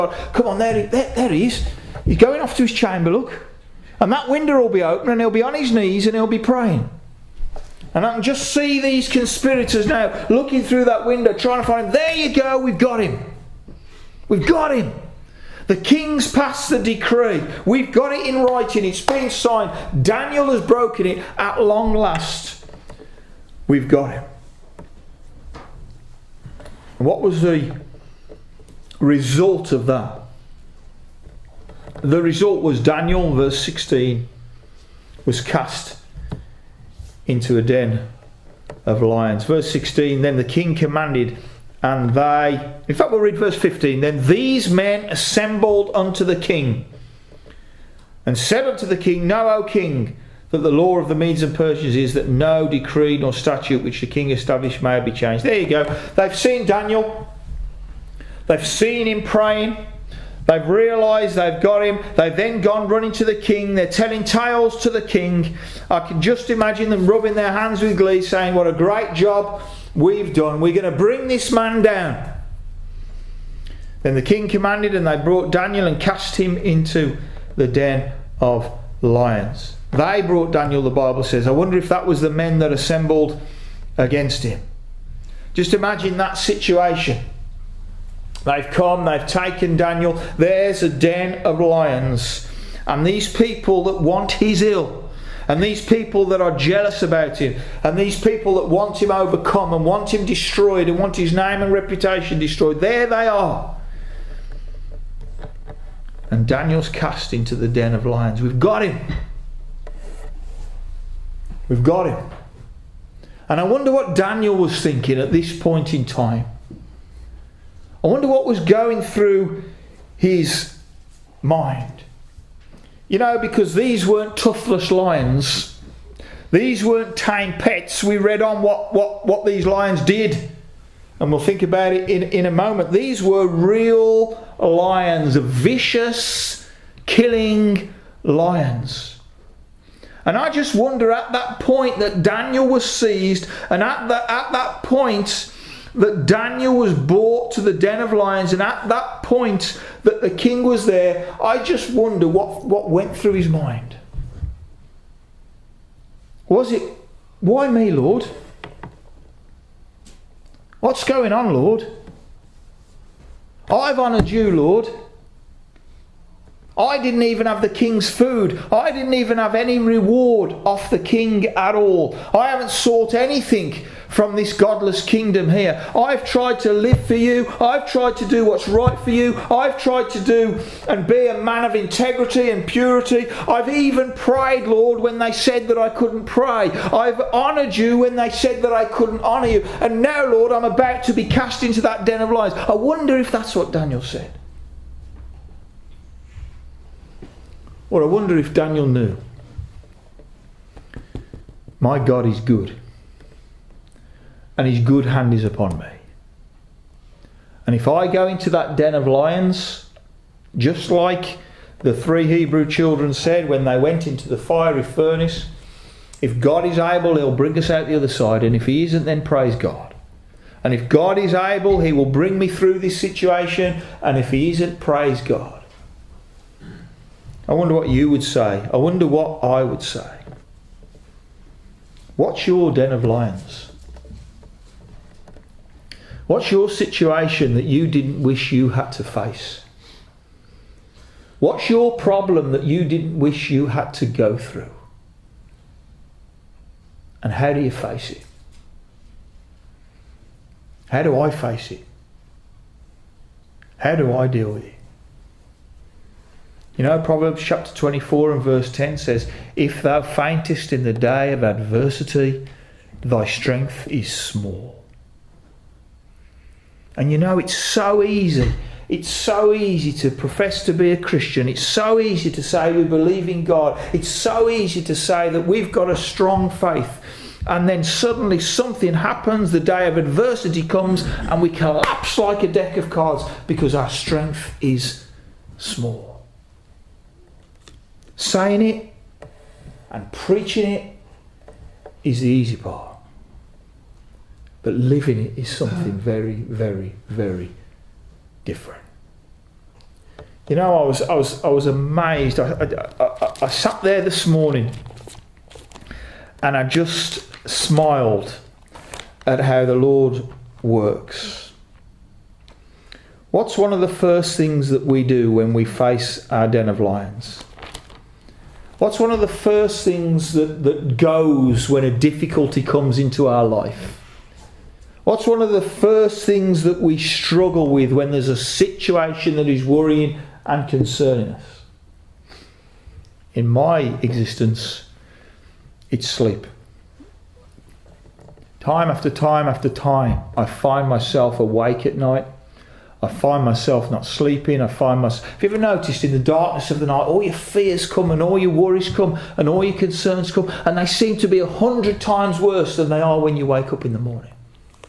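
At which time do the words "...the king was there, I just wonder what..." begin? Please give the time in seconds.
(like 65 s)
150 s.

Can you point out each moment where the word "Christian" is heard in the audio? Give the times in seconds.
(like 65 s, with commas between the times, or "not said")
270 s.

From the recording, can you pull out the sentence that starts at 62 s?
They've then gone running to the king.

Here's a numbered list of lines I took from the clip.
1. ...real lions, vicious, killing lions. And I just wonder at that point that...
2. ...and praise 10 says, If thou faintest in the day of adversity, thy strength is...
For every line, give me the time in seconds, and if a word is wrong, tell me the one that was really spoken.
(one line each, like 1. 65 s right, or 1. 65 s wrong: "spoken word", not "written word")
1. 133 s right
2. 258 s wrong: "verse", not "praise".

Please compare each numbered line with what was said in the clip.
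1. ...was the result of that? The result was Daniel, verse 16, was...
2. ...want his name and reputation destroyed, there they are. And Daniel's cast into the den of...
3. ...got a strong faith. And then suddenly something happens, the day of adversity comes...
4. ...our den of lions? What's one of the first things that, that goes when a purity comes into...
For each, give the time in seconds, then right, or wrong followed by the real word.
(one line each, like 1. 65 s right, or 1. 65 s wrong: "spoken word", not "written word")
1. 27 s right
2. 100 s right
3. 275 s right
4. 316 s wrong: "difficulty", not "purity".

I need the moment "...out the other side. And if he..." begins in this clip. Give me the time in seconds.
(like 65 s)
217 s.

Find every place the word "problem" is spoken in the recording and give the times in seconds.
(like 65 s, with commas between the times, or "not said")
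241 s.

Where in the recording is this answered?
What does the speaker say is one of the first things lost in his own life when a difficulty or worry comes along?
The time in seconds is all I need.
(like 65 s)
336 s.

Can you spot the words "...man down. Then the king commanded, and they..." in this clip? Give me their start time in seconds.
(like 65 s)
71 s.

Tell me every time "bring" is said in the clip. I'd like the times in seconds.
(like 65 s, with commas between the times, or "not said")
70 s, 217 s, 222 s.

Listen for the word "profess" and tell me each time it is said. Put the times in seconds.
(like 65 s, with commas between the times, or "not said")
270 s.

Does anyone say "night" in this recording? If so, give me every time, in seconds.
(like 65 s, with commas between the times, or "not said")
341 s, 346 s.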